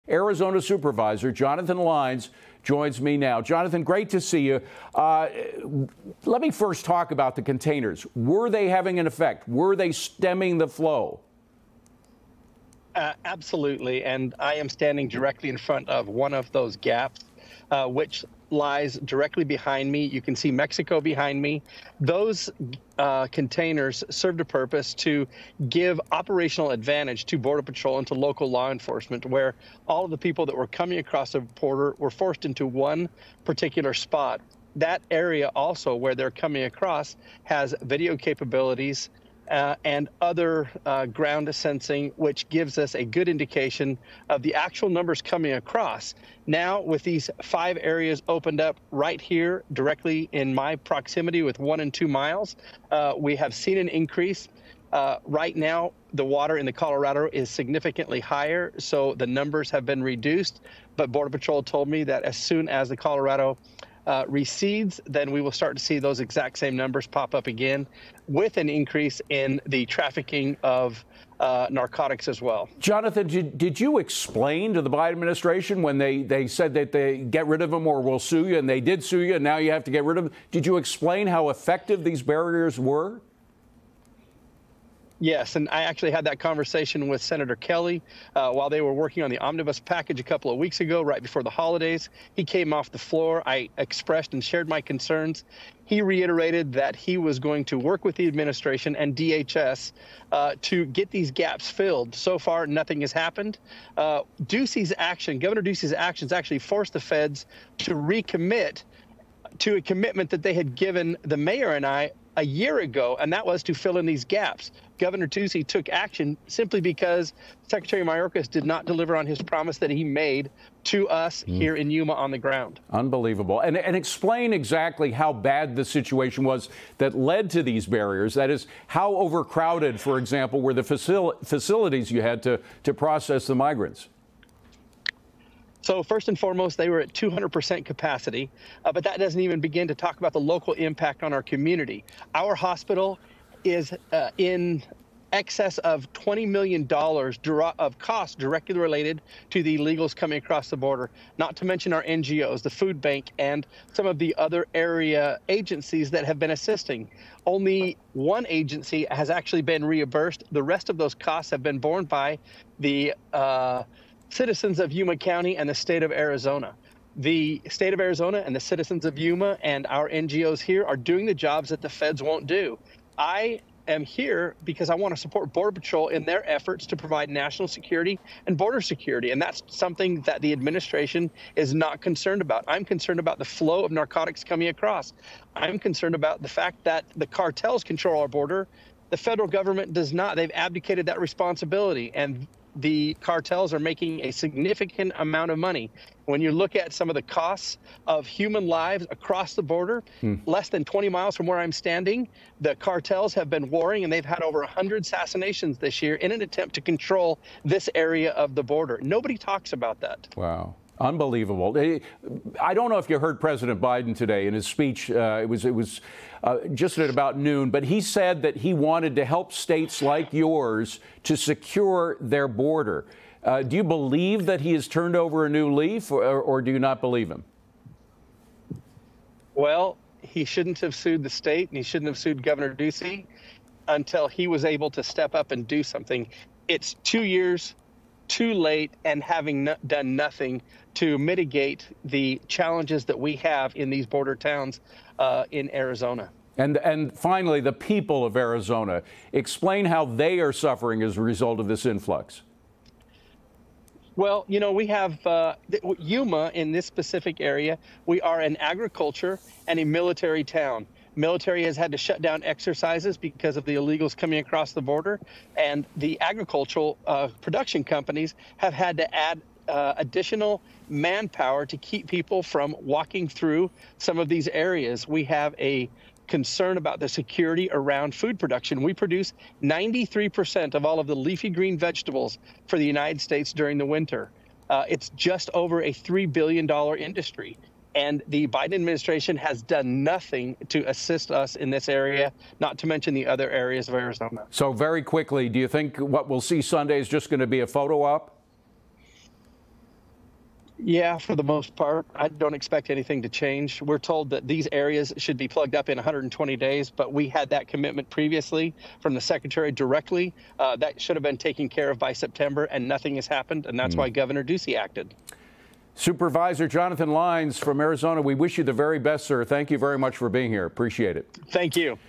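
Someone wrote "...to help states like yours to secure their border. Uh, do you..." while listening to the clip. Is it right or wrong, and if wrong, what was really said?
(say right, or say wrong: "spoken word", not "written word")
right.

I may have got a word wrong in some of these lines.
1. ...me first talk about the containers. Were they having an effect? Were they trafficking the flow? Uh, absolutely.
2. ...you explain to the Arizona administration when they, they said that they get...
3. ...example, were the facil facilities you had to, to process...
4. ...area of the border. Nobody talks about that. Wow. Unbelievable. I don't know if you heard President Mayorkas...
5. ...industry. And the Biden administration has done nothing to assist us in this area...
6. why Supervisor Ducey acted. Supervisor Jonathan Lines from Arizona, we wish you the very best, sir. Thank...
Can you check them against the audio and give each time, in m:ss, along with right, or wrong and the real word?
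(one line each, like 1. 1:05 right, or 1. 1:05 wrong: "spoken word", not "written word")
1. 0:06 wrong: "stemming", not "trafficking"
2. 1:13 wrong: "Biden", not "Arizona"
3. 2:10 right
4. 3:27 wrong: "Biden", not "Mayorkas"
5. 4:46 right
6. 5:13 wrong: "Governor", not "Supervisor".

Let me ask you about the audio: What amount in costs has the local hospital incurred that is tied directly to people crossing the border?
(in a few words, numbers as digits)
$20 million.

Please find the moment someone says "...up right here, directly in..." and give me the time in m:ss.
0:48.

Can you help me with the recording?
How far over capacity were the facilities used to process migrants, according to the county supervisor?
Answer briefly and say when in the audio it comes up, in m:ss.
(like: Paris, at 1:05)
200%, at 2:17.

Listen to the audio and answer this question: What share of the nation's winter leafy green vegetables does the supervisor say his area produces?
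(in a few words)
93%.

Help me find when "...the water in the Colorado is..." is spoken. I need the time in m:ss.
0:56.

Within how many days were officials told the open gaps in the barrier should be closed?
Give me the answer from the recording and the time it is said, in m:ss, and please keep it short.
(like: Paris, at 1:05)
120 days, at 5:05.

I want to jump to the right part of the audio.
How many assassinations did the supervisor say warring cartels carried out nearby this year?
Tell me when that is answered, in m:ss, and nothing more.
3:24.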